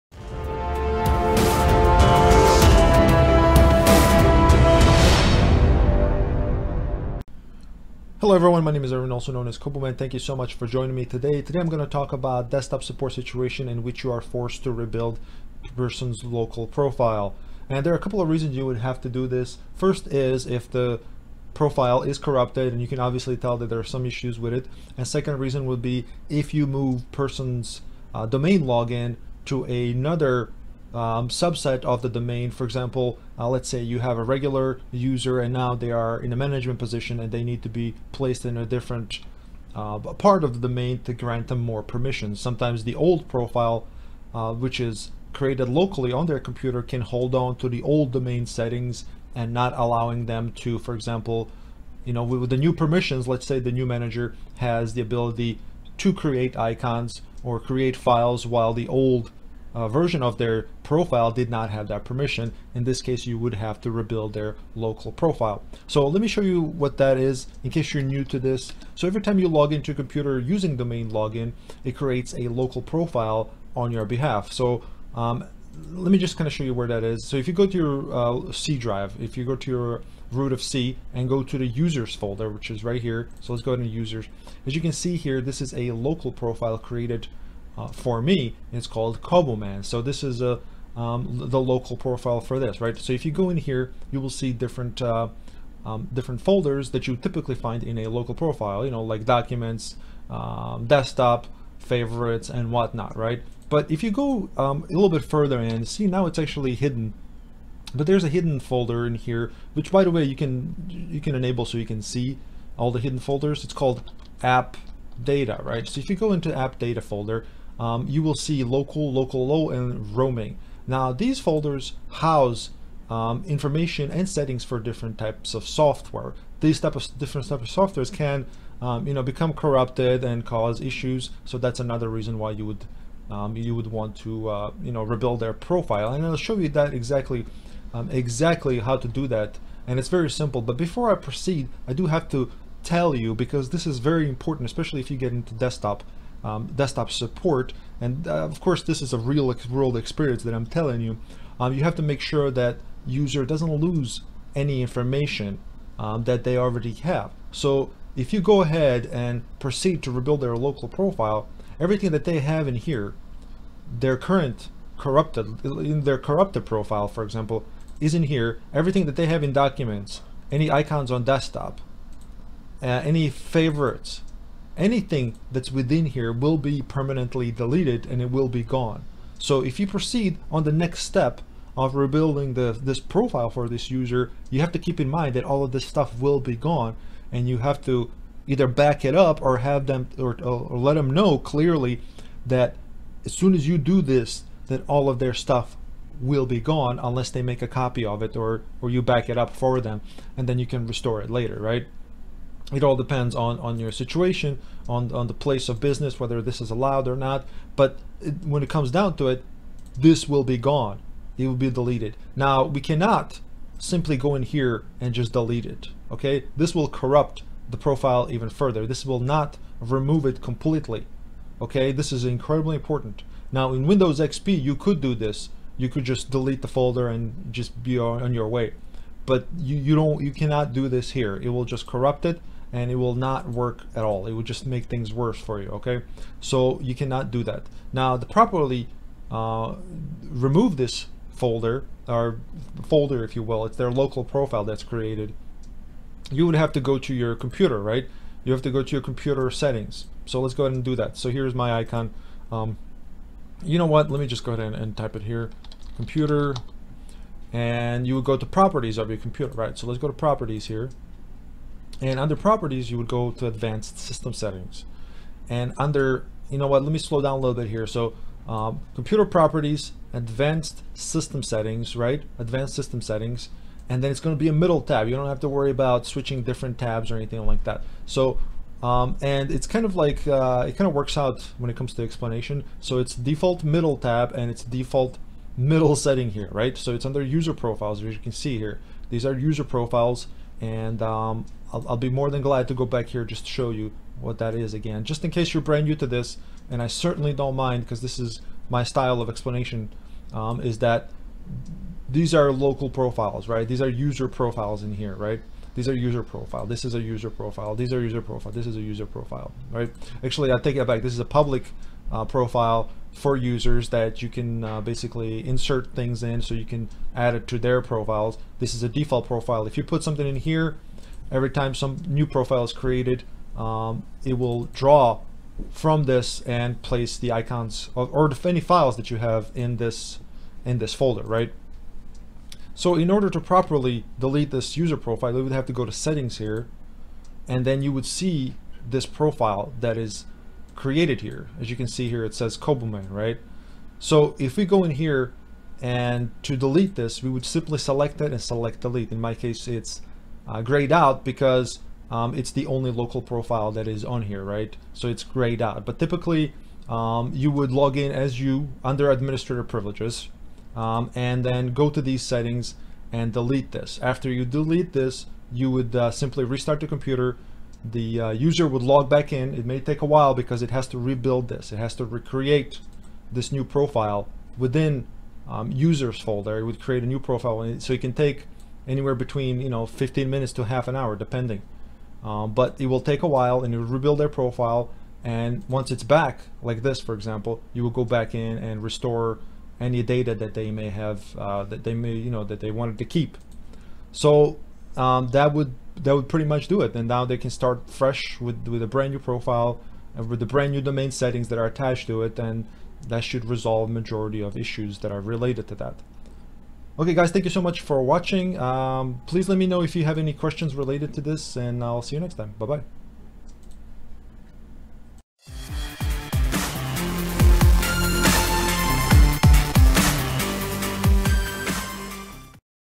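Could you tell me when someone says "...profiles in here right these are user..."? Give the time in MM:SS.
05:04.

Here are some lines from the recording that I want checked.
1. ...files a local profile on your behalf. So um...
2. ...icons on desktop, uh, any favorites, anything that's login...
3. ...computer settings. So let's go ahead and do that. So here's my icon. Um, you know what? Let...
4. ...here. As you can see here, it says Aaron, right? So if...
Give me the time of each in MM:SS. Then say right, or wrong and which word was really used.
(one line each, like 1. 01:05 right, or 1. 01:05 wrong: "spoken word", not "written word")
1. 01:11 wrong: "creates", not "files"
2. 02:50 wrong: "within", not "login"
3. 04:09 right
4. 05:41 wrong: "Cobuman", not "Aaron".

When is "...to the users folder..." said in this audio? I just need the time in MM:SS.
01:21.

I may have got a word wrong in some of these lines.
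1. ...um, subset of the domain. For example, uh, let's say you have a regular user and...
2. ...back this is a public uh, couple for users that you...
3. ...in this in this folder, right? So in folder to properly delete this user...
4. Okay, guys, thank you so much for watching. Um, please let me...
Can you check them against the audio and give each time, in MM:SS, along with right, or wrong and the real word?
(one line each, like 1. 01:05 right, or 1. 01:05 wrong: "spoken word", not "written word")
1. 00:30 right
2. 05:10 wrong: "profile", not "couple"
3. 05:29 wrong: "order", not "folder"
4. 06:46 right.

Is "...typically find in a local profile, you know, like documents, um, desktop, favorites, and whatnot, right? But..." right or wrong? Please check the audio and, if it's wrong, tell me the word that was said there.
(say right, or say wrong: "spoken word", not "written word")
right.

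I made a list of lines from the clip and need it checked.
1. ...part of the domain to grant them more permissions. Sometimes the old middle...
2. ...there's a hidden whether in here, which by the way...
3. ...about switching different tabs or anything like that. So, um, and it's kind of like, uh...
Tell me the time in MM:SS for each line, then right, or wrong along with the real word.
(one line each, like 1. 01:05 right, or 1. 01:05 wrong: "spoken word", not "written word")
1. 00:39 wrong: "profile", not "middle"
2. 01:48 wrong: "folder", not "whether"
3. 04:35 right.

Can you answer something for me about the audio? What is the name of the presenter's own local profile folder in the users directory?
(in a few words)
Man.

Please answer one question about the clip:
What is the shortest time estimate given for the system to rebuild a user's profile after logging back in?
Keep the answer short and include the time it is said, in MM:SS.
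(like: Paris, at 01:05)
15 minutes, at 06:19.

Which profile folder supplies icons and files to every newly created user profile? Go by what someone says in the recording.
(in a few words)
default profile.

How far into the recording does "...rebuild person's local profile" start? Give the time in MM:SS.
00:14.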